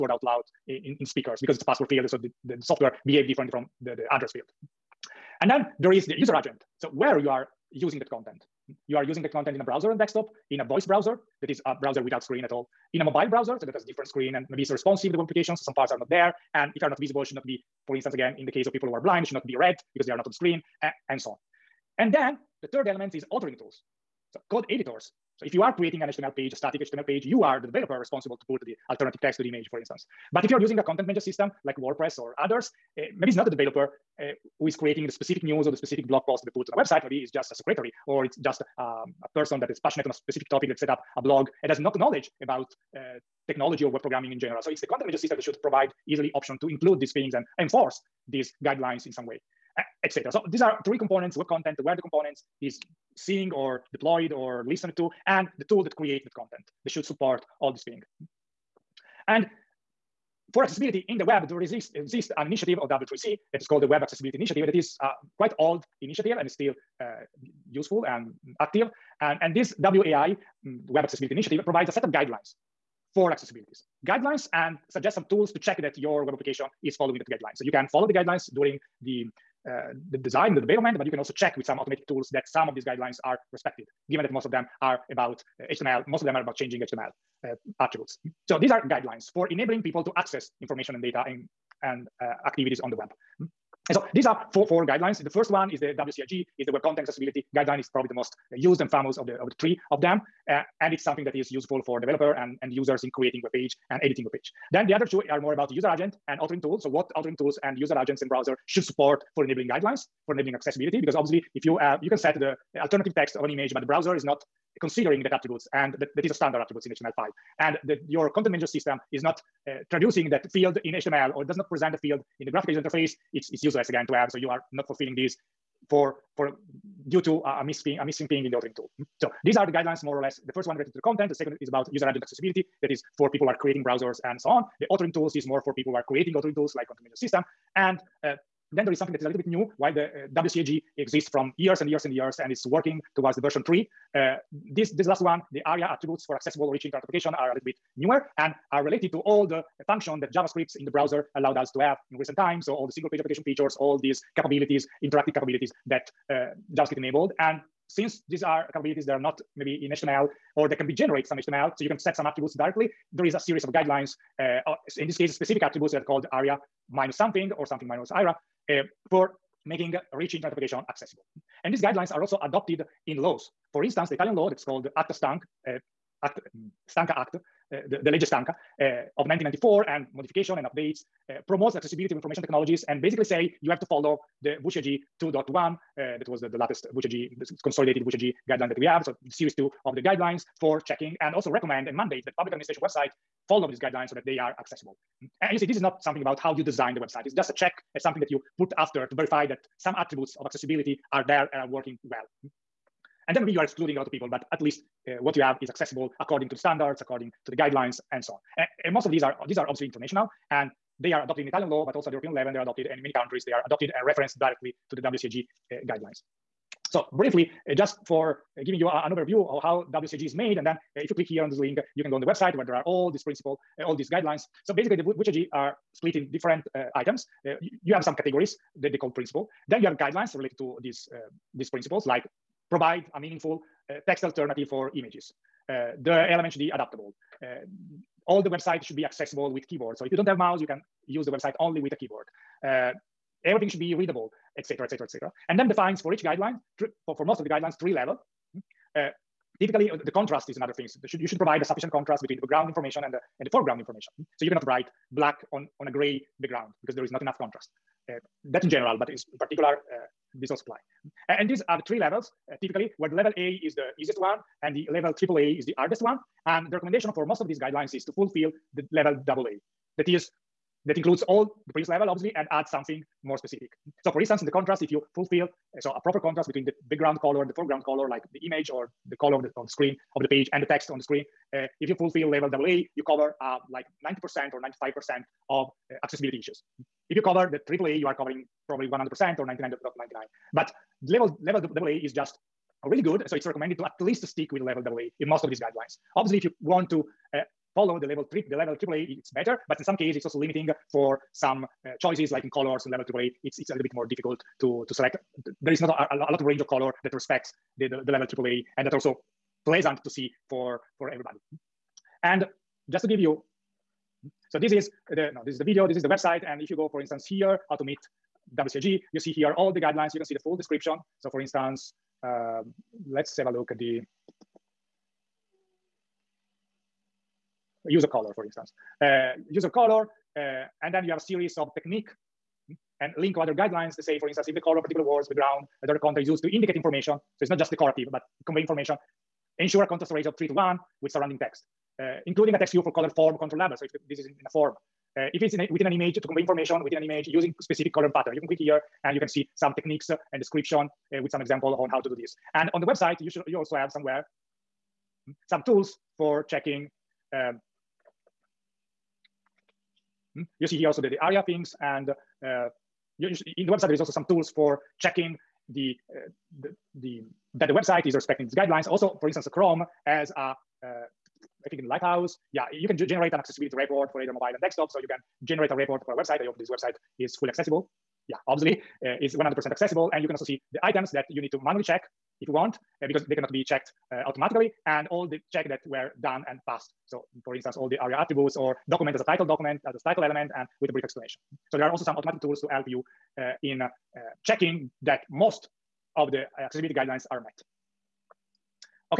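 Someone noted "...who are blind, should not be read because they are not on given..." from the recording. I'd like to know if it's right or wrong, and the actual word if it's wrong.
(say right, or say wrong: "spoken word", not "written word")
wrong: "screen", not "given".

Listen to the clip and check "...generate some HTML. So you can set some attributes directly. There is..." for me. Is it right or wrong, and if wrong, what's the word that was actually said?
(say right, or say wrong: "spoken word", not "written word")
right.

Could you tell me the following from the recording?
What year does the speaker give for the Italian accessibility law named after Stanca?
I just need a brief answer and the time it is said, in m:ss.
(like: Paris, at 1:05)
1994, at 2:59.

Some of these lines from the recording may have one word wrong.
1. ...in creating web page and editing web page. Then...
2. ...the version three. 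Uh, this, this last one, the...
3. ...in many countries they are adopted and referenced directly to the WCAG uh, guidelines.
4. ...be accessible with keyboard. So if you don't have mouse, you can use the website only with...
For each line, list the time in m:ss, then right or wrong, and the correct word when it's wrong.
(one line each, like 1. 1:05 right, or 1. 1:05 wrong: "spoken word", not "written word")
1. 1:43 right
2. 2:23 right
3. 3:32 right
4. 3:58 right.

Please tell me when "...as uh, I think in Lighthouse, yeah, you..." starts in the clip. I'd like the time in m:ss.
6:10.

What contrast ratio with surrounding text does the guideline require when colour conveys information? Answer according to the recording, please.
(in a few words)
3 to 1.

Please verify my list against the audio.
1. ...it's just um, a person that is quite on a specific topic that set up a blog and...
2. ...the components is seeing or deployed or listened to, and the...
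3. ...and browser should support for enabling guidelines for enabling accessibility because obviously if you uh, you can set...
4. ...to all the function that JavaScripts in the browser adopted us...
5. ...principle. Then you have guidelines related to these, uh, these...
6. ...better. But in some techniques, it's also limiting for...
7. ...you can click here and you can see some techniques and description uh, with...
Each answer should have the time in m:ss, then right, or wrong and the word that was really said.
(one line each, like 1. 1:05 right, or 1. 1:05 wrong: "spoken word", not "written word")
1. 0:38 wrong: "passionate", not "quite"
2. 0:51 right
3. 1:48 right
4. 2:29 wrong: "allowed", not "adopted"
5. 3:49 right
6. 4:59 wrong: "cases", not "techniques"
7. 5:48 right.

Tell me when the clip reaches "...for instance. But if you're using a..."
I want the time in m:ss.
0:29.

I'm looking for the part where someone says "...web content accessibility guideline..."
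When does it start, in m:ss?
1:36.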